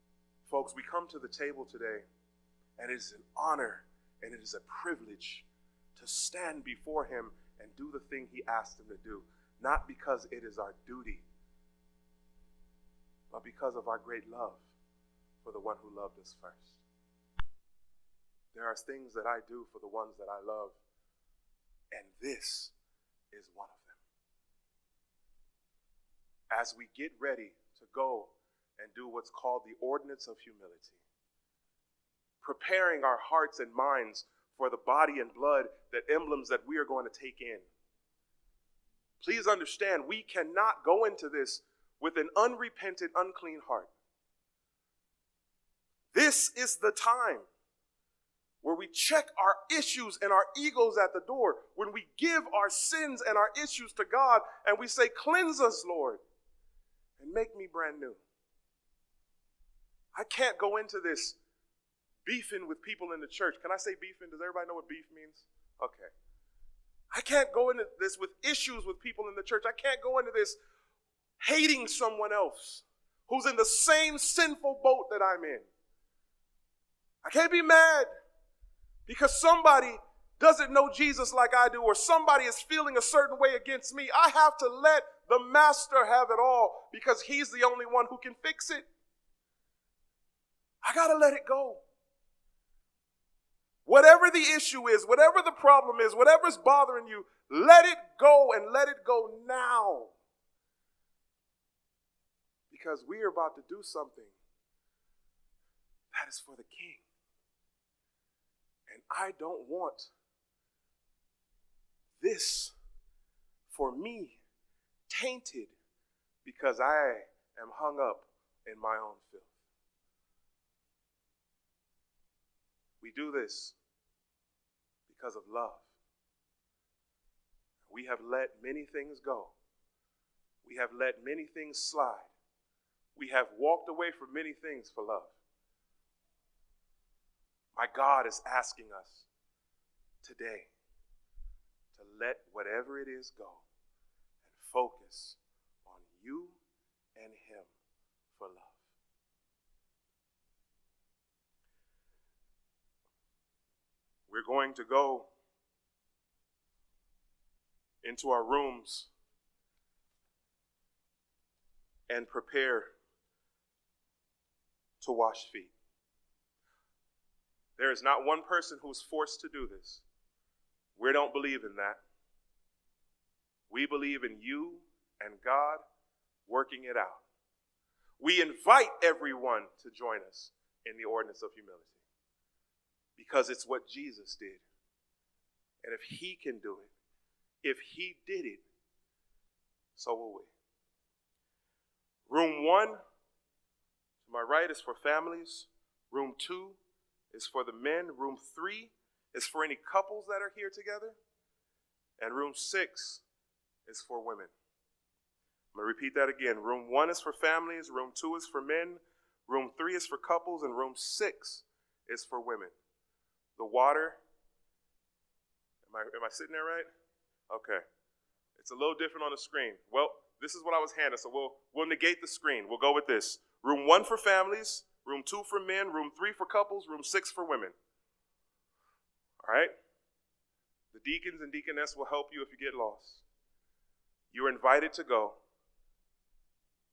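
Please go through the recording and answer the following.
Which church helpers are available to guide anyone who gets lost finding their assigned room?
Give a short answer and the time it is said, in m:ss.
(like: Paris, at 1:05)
deacons and deaconess, at 3:51.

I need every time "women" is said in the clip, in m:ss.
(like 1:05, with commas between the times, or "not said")
3:24, 3:32, 3:47.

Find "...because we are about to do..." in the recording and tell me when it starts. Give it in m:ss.
1:42.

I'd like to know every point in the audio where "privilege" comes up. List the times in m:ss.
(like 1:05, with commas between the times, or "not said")
0:04.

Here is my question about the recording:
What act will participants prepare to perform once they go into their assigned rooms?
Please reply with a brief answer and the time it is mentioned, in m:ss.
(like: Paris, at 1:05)
wash feet, at 2:45.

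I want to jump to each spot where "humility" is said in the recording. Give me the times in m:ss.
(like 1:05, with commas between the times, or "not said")
0:30, 3:01.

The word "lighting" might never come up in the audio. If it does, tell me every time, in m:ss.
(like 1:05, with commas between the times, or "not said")
not said.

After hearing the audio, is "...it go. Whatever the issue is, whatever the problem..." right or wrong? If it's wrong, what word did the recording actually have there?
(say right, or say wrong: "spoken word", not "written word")
right.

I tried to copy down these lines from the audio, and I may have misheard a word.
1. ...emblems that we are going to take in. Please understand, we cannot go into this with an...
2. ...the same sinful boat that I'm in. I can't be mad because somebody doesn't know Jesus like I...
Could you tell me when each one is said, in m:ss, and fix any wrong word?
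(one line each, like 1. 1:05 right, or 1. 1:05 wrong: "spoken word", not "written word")
1. 0:36 right
2. 1:13 right.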